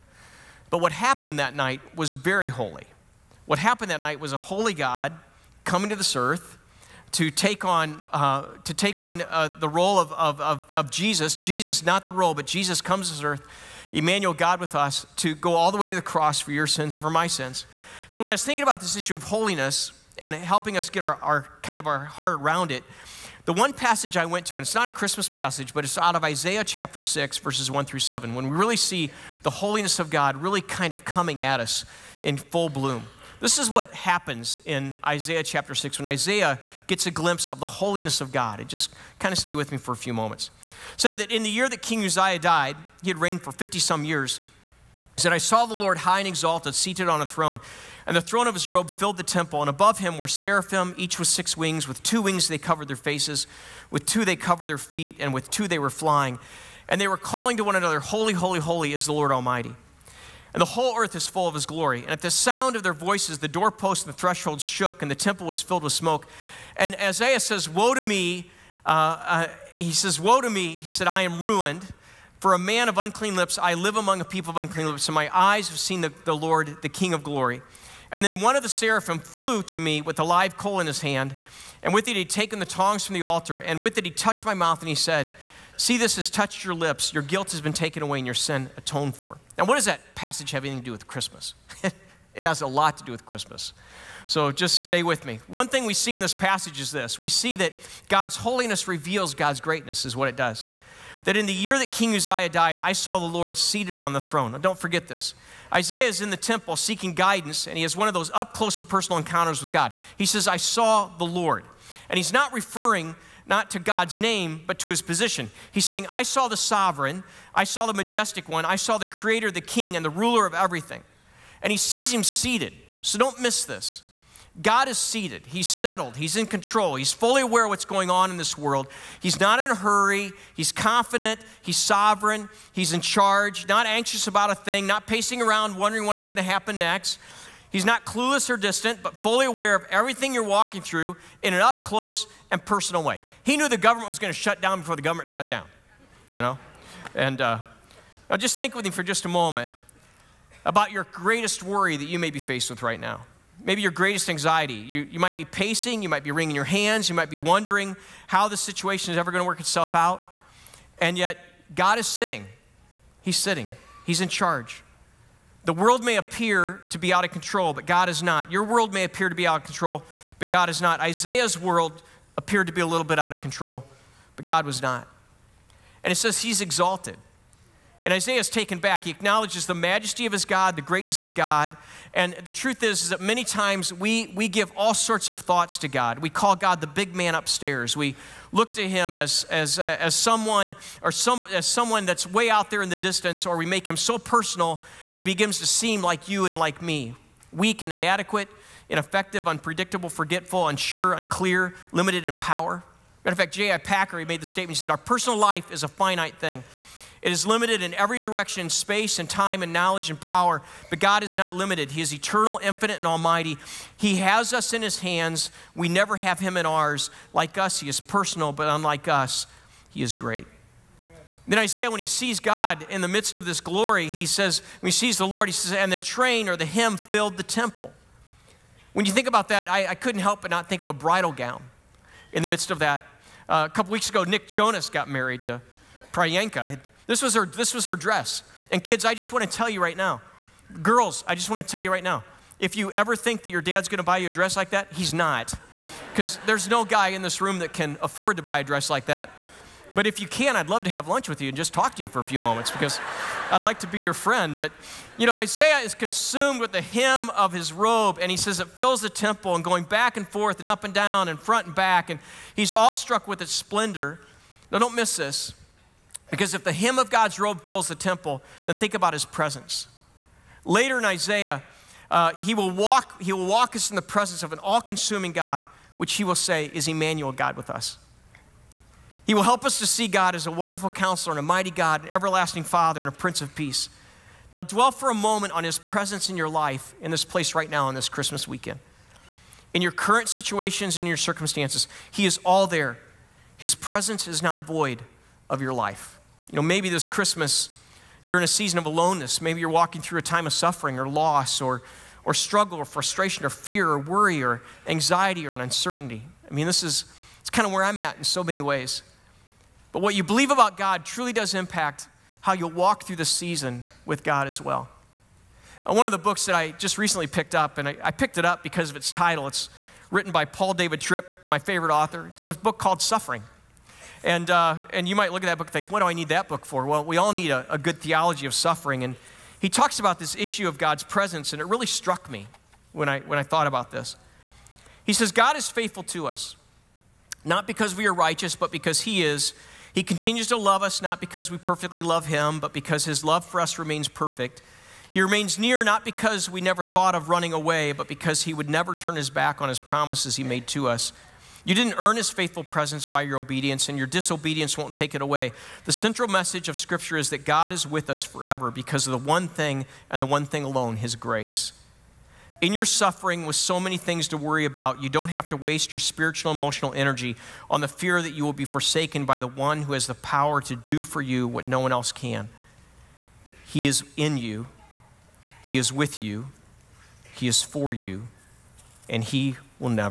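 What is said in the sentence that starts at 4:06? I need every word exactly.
Because there's no guy in this room that can afford to buy a dress like that.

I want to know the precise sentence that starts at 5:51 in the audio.
You didn't earn his faithful presence by your obedience, and your disobedience won't take it away.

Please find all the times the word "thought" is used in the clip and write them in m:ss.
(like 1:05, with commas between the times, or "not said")
3:05, 5:33, 5:46.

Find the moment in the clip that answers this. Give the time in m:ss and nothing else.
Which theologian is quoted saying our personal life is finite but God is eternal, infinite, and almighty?
3:23.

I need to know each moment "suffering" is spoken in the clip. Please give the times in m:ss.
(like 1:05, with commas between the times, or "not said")
5:00, 5:22, 5:28, 6:02.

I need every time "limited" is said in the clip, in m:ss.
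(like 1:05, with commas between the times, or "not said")
3:21, 3:27, 3:31.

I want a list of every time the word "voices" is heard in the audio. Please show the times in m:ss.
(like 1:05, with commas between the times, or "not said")
1:02.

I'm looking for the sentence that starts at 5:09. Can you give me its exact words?
But what you believe about God truly does impact how you'll walk through the season with God as well.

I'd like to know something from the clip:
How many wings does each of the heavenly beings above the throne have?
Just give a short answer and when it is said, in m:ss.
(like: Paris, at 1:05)
6, at 0:51.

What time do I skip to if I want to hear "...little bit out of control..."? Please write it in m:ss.
2:52.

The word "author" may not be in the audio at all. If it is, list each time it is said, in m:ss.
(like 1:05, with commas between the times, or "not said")
5:21.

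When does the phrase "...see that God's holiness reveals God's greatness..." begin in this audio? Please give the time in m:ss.
1:37.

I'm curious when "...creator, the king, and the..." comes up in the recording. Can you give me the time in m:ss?
1:59.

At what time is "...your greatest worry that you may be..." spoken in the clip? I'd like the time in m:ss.
2:30.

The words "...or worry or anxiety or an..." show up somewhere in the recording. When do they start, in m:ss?
5:03.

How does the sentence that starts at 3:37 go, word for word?
Like us, he is personal, but unlike us, he is great.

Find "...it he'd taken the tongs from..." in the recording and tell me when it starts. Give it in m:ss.
1:22.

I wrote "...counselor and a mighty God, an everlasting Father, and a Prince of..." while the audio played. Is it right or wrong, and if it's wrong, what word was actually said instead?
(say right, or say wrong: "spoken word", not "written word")
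right.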